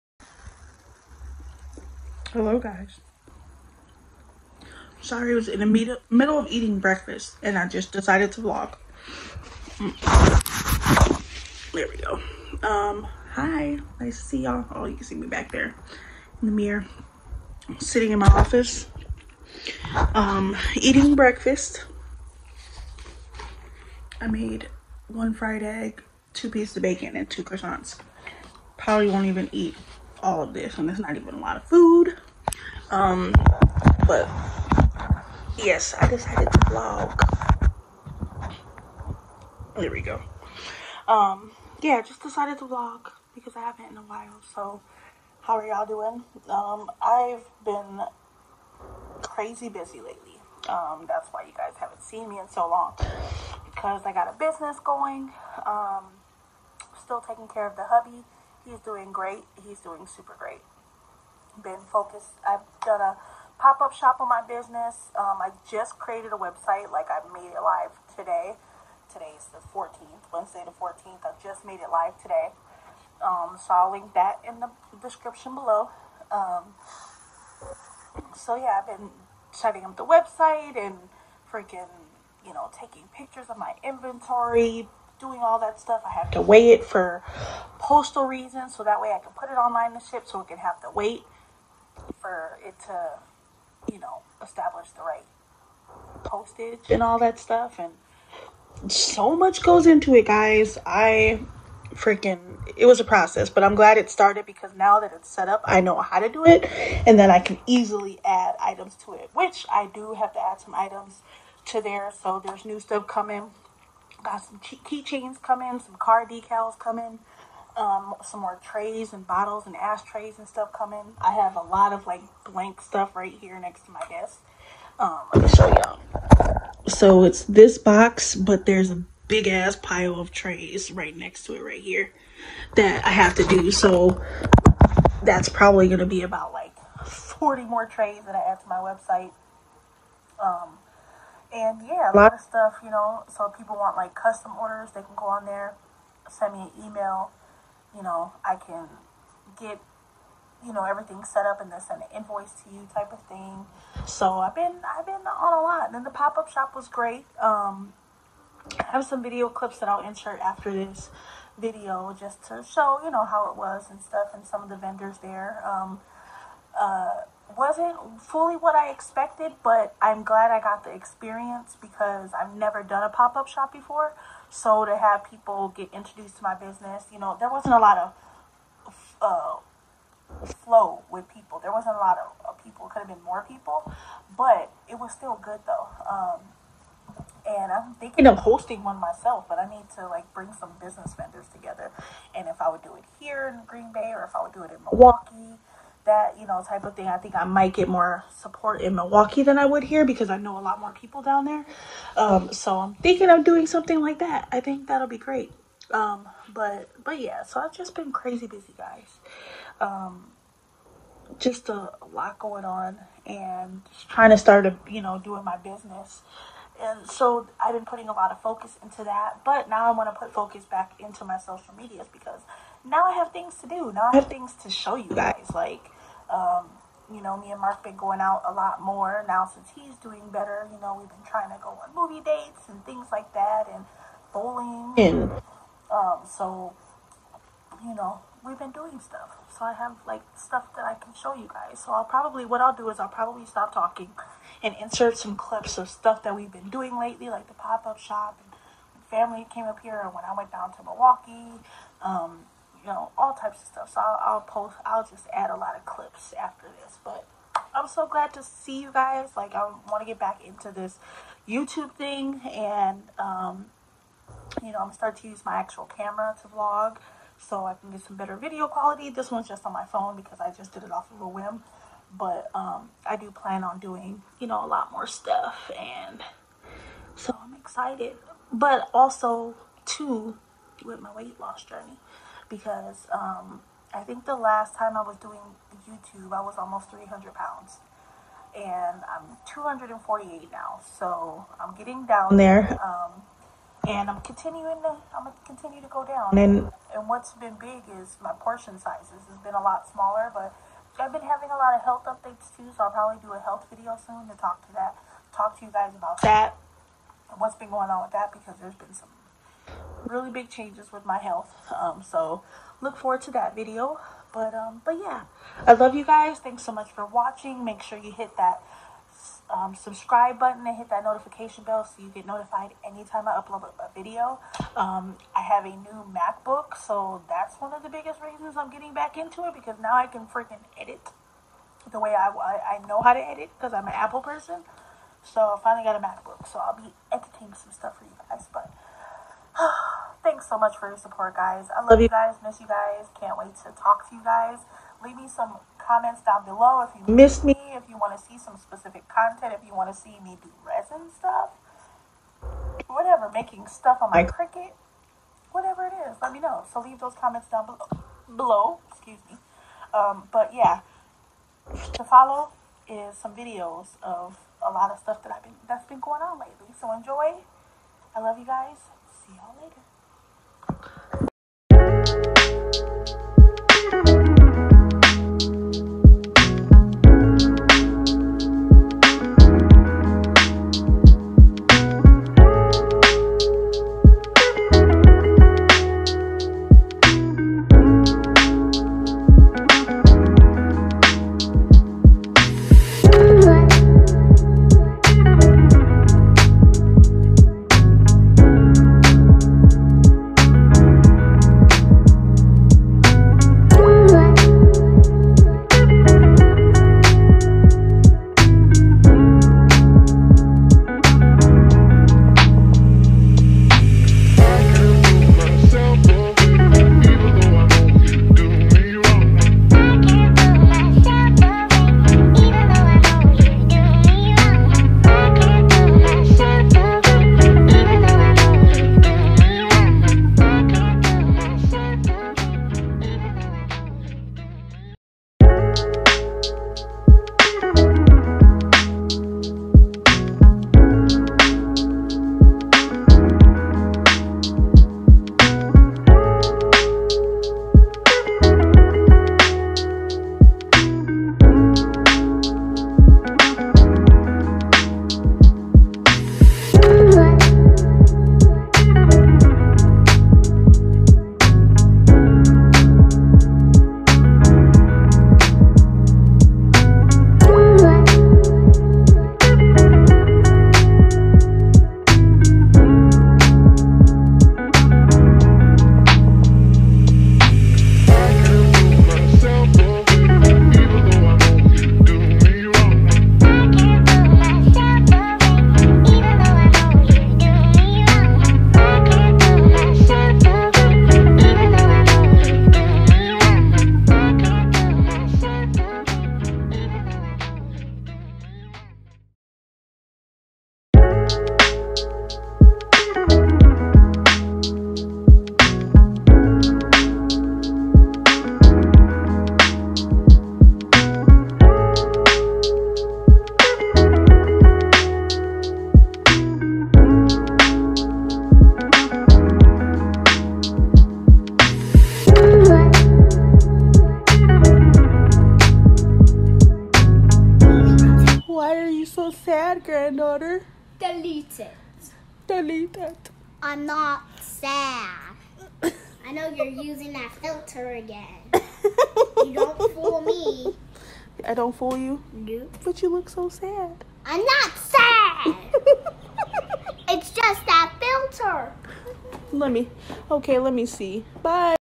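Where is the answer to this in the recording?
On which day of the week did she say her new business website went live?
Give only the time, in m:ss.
1:10.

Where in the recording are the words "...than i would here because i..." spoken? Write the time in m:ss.
3:19.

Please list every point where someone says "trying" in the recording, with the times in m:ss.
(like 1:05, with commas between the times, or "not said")
3:34, 3:51.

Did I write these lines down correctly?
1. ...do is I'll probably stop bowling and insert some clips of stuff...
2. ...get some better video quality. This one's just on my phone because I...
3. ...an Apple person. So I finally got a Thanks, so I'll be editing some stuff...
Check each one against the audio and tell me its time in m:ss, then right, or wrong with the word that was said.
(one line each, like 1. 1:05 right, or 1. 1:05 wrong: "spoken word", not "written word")
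1. 4:02 wrong: "talking", not "bowling"
2. 4:27 right
3. 5:33 wrong: "MacBook", not "Thanks".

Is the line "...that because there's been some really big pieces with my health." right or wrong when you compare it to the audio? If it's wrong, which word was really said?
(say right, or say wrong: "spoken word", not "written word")
wrong: "changes", not "pieces".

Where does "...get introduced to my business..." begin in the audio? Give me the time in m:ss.
2:55.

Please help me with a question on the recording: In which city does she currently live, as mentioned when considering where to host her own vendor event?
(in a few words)
Green Bay.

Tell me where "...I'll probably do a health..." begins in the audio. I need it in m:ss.
5:02.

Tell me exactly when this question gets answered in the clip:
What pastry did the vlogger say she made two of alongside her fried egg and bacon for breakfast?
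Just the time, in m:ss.
0:27.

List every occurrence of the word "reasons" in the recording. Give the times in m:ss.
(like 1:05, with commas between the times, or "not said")
1:28, 5:28.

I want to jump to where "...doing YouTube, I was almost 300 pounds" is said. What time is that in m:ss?
4:45.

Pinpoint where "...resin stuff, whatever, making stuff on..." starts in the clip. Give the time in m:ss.
5:50.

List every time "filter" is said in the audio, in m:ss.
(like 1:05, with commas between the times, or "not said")
8:57, 9:07.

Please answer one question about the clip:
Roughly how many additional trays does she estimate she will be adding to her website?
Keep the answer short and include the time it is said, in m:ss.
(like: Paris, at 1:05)
40, at 2:17.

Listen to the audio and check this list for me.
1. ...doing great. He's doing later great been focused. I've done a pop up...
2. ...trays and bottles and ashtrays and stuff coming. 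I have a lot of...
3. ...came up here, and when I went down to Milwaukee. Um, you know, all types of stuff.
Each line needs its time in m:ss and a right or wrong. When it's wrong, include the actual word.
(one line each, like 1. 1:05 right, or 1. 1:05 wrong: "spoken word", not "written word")
1. 0:58 wrong: "super", not "later"
2. 1:58 right
3. 4:09 right.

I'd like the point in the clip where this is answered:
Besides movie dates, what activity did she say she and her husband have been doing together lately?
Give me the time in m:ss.
3:54.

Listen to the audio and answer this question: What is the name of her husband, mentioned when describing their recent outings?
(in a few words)
Mark.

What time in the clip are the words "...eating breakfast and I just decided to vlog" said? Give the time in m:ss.
0:06.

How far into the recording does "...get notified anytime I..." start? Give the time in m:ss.
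5:22.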